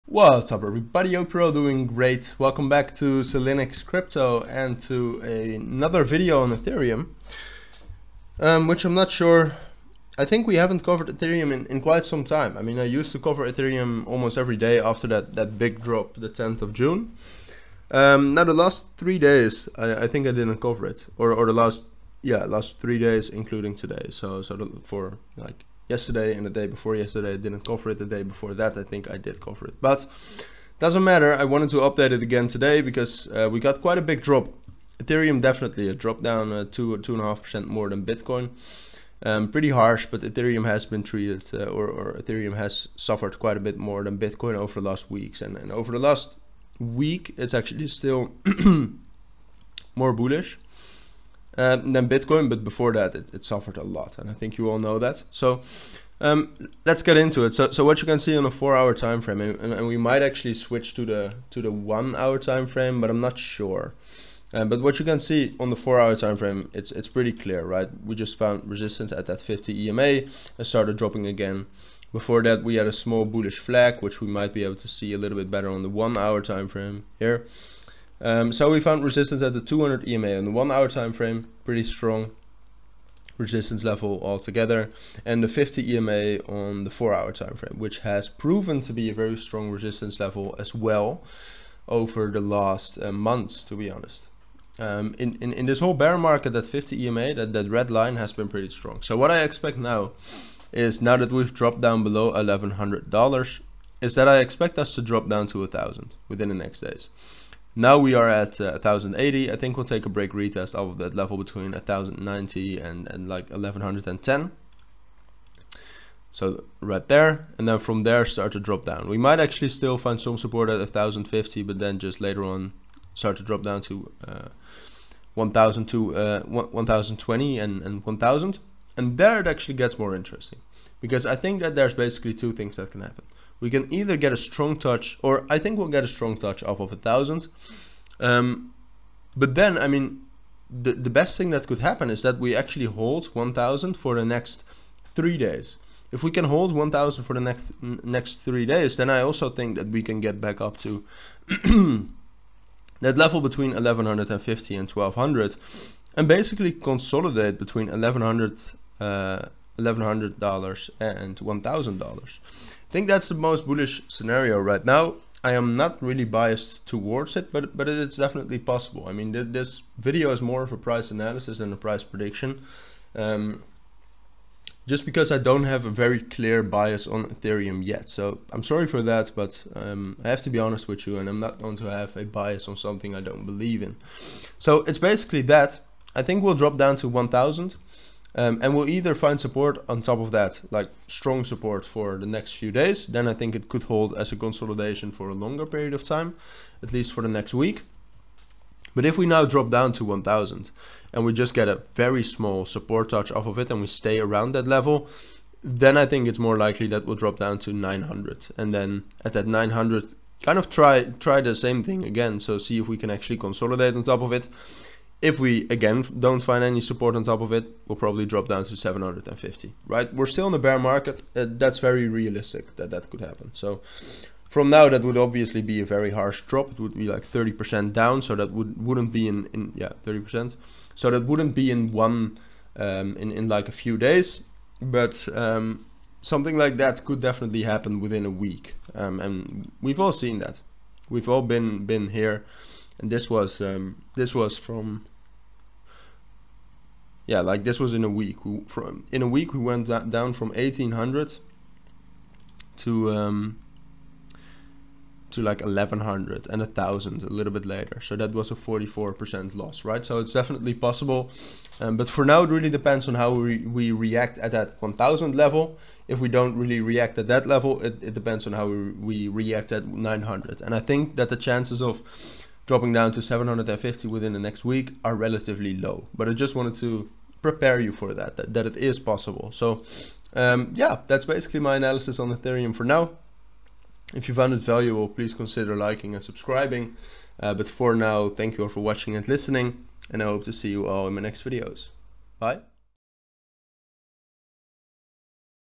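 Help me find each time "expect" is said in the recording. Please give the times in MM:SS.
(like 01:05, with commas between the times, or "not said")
01:39, 01:44.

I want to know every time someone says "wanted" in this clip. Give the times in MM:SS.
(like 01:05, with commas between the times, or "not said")
00:31, 04:36.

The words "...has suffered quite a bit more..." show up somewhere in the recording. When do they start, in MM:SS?
00:42.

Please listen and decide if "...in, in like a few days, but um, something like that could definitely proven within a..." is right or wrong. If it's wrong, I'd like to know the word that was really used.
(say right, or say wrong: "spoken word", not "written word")
wrong: "happen", not "proven".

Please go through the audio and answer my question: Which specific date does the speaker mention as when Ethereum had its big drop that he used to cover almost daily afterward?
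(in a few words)
10th of June.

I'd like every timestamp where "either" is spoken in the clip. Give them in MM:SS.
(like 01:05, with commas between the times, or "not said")
02:13, 03:08.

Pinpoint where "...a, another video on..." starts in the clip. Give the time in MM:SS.
00:05.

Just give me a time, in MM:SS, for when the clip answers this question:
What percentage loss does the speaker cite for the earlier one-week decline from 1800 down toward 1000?
04:18.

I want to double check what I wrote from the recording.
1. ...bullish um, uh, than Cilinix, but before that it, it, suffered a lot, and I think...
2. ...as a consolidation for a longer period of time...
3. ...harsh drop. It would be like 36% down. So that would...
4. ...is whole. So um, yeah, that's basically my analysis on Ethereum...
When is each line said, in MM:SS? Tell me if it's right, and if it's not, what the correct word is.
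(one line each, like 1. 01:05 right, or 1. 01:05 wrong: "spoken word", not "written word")
1. 00:50 wrong: "Bitcoin", not "Cilinix"
2. 03:14 right
3. 03:46 wrong: "30", not "36"
4. 04:38 wrong: "possible", not "whole".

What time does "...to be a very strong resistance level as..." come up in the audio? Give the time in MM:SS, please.
01:28.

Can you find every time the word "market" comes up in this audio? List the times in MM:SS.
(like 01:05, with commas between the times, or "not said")
01:36, 03:40.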